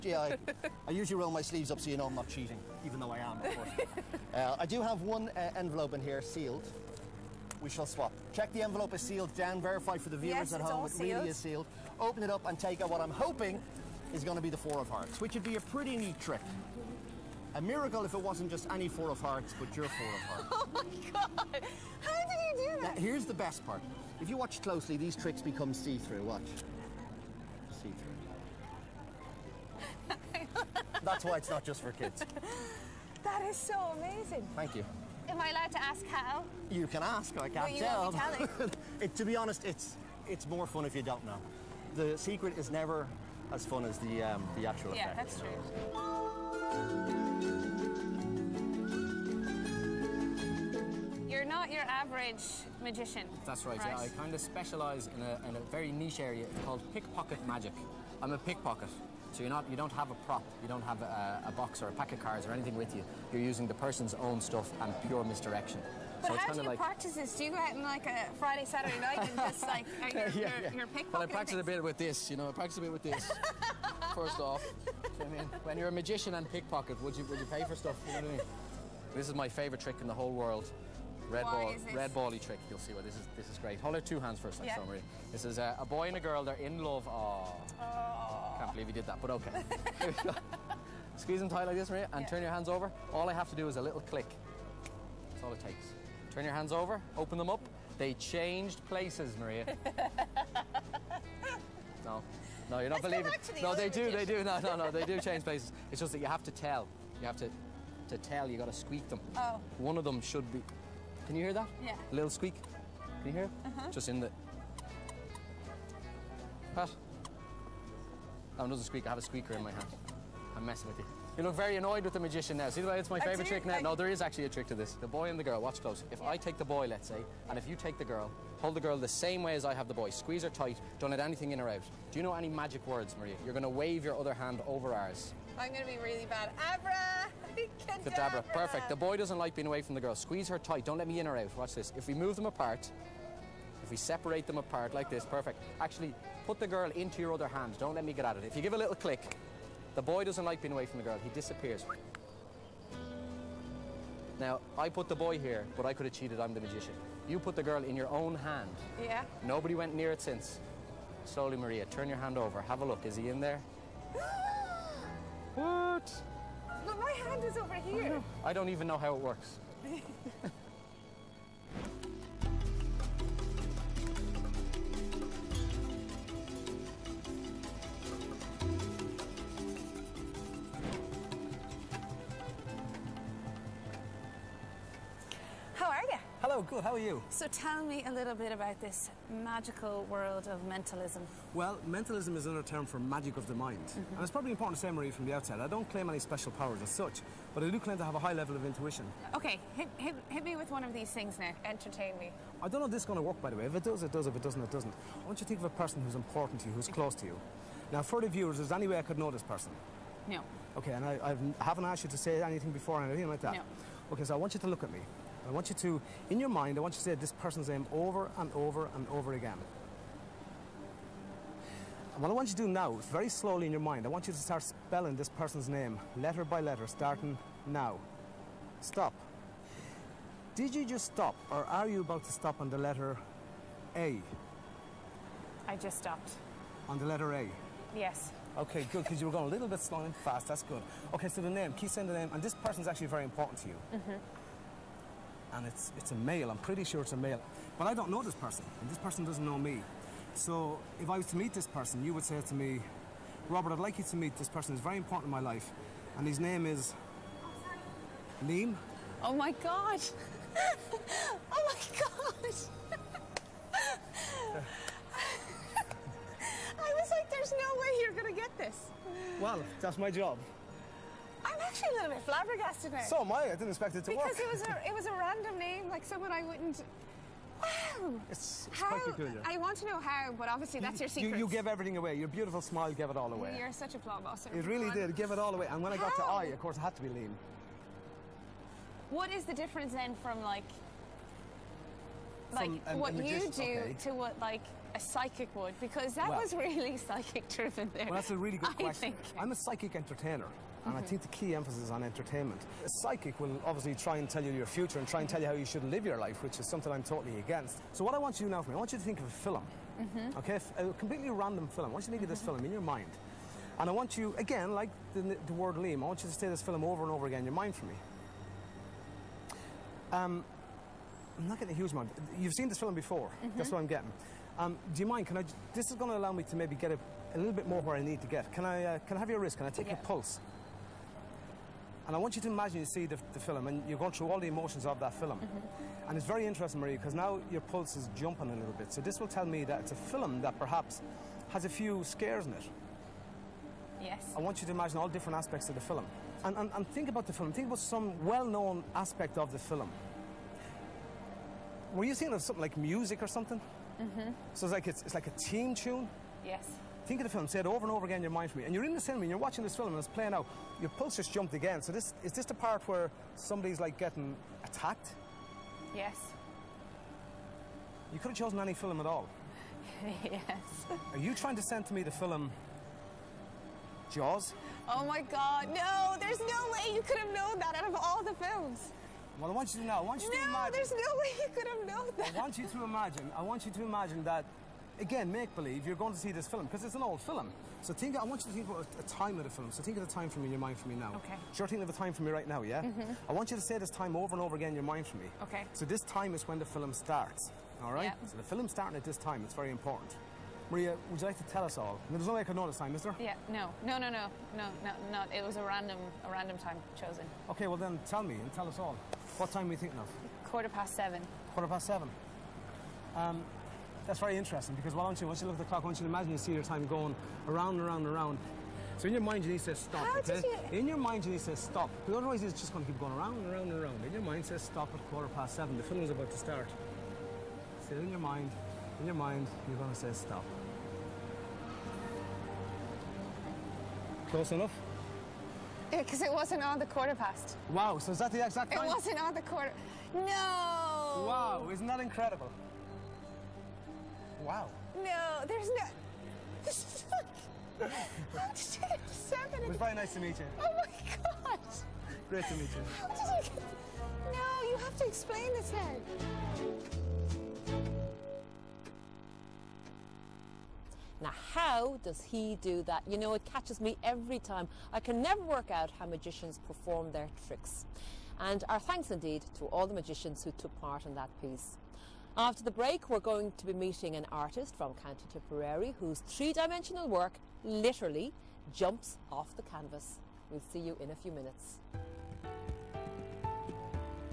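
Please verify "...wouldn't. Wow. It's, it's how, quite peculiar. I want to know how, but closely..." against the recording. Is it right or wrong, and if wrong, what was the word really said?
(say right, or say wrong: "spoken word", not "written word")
wrong: "obviously", not "closely".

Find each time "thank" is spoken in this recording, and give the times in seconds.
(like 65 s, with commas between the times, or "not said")
34 s, 468 s.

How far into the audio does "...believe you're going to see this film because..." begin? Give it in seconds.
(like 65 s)
385 s.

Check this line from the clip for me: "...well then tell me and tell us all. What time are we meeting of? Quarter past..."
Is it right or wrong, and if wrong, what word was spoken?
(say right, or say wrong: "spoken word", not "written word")
wrong: "thinking", not "meeting".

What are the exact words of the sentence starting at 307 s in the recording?
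So what I want you to do now for me, I want you to think of a film, mm -hmm.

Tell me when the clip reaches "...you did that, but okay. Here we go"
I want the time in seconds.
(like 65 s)
88 s.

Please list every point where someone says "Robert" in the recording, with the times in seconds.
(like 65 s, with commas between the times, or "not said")
253 s.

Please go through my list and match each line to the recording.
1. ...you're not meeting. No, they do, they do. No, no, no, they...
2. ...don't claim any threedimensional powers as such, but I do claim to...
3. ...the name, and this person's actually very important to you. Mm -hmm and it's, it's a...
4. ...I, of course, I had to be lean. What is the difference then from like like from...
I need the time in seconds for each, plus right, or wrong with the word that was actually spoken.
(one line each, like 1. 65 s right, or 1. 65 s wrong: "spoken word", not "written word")
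1. 102 s wrong: "believing", not "meeting"
2. 195 s wrong: "special", not "threedimensional"
3. 242 s right
4. 286 s right.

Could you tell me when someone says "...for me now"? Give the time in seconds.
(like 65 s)
390 s.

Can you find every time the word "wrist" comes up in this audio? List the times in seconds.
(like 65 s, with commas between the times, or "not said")
329 s.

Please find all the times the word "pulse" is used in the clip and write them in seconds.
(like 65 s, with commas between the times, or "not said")
330 s, 337 s, 360 s.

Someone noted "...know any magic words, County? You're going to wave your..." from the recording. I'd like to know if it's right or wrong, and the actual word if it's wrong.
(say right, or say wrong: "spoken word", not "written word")
wrong: "Maria", not "County".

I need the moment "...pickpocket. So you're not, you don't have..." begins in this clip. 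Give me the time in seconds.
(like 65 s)
58 s.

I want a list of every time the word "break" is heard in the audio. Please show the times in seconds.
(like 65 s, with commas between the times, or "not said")
472 s.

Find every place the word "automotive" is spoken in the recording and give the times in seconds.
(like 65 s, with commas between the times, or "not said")
not said.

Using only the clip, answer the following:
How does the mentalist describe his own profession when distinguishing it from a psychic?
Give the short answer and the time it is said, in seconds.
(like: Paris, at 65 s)
psychic entertainer, at 299 s.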